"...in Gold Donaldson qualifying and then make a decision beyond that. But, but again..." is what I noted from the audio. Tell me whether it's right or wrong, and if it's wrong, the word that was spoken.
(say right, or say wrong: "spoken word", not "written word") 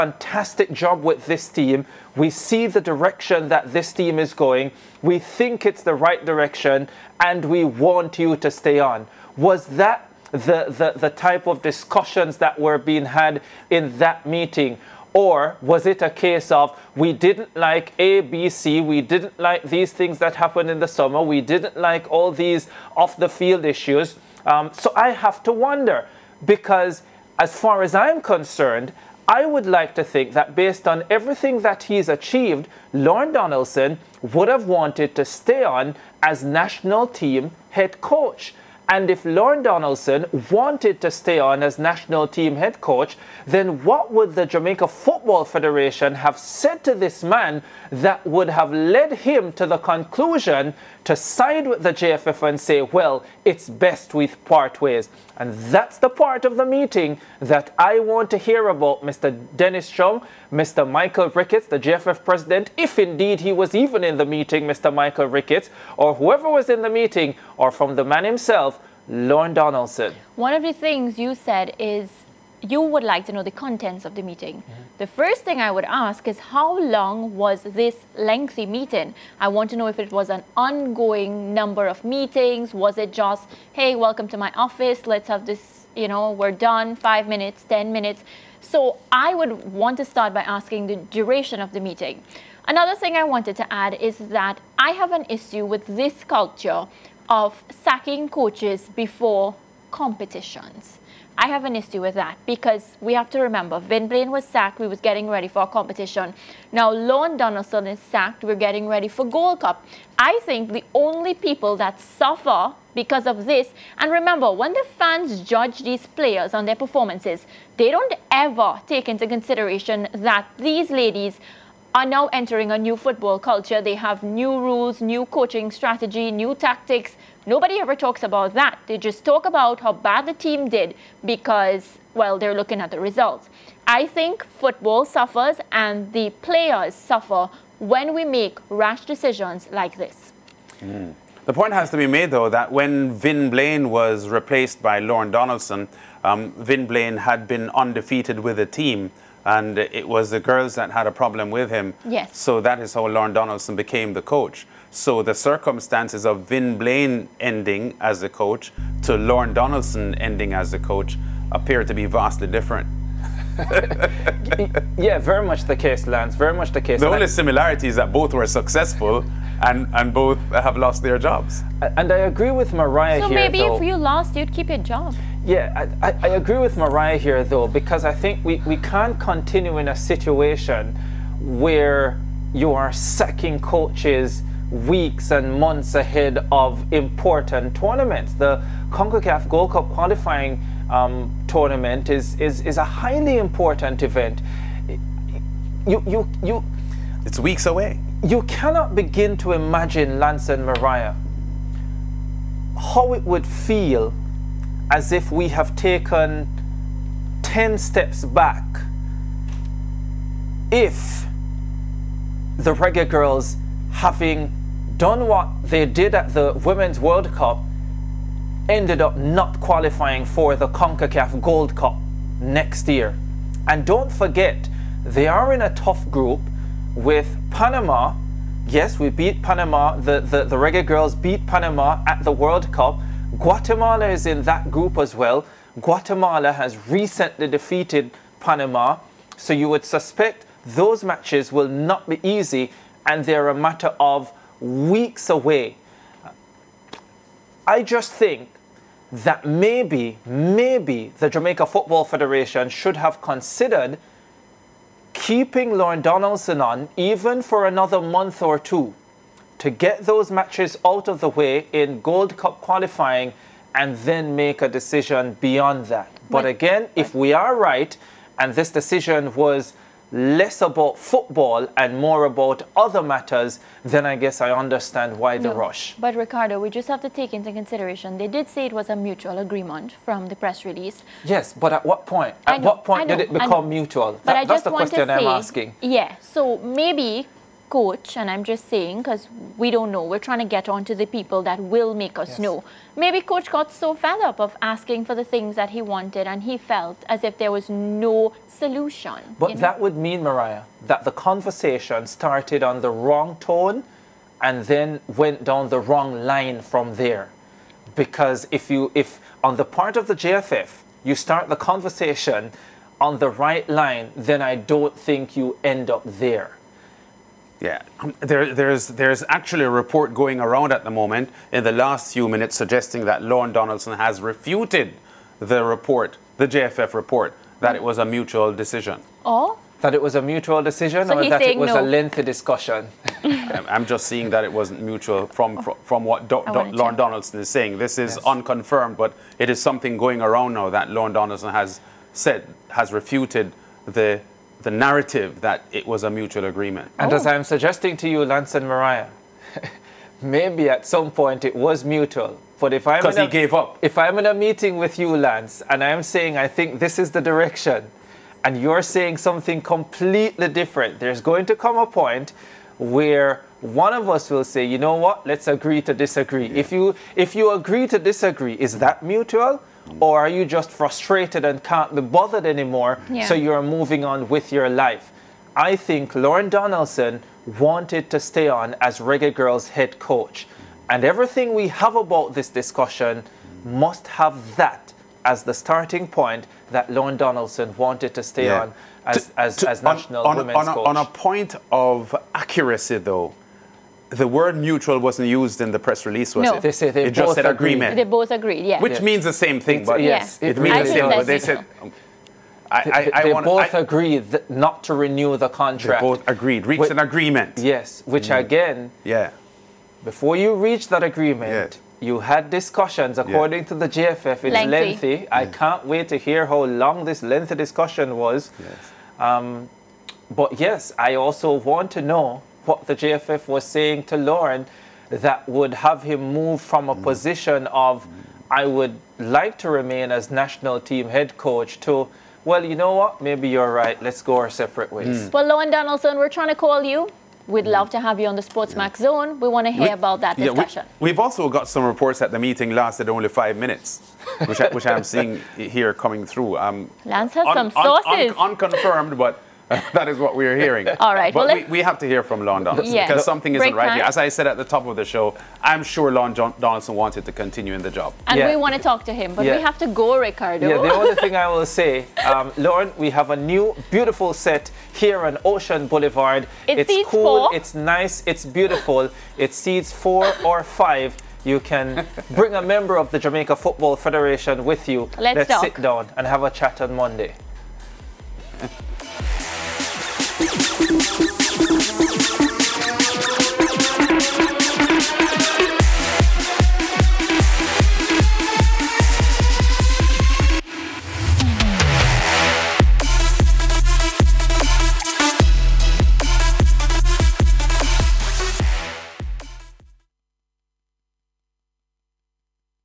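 wrong: "Cup", not "Donaldson".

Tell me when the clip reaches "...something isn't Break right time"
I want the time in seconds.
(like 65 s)
453 s.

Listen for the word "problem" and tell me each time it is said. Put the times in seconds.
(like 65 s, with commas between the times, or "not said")
151 s.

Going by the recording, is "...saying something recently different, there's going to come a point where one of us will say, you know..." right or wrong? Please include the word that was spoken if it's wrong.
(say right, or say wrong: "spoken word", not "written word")
wrong: "completely", not "recently".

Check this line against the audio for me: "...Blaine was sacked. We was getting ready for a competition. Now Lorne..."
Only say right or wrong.
right.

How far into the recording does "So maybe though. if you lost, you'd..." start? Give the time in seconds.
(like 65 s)
173 s.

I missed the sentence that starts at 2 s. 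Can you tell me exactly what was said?
We see the direction that this team is going.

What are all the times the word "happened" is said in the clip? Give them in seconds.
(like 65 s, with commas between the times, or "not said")
20 s.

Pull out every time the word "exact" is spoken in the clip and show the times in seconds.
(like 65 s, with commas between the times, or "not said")
not said.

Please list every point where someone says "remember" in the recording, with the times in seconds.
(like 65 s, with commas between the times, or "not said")
103 s, 114 s.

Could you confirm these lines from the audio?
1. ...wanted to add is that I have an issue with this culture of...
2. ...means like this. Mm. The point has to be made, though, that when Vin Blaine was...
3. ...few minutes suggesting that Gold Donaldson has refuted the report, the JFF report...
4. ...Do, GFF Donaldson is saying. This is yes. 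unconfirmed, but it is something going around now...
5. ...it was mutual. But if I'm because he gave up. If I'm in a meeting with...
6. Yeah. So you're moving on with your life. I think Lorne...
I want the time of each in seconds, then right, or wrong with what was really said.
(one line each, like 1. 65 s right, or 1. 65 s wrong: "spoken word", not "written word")
1. 93 s right
2. 139 s wrong: "decisions", not "means"
3. 322 s wrong: "Lorne", not "Gold"
4. 336 s wrong: "Lorne", not "GFF"
5. 351 s right
6. 373 s right.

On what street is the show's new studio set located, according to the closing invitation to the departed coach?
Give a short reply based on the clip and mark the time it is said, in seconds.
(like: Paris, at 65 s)
Ocean Boulevard, at 465 s.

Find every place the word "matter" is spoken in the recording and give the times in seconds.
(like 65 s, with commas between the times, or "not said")
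243 s, 273 s.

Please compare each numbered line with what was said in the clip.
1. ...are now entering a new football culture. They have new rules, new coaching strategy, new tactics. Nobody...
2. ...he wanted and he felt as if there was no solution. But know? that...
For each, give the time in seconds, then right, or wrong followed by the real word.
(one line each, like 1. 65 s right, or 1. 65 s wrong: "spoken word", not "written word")
1. 121 s right
2. 295 s right.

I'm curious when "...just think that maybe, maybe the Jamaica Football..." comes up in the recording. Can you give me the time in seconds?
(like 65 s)
247 s.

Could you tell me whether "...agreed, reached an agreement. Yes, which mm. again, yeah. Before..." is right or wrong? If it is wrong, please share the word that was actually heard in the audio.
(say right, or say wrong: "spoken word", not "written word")
right.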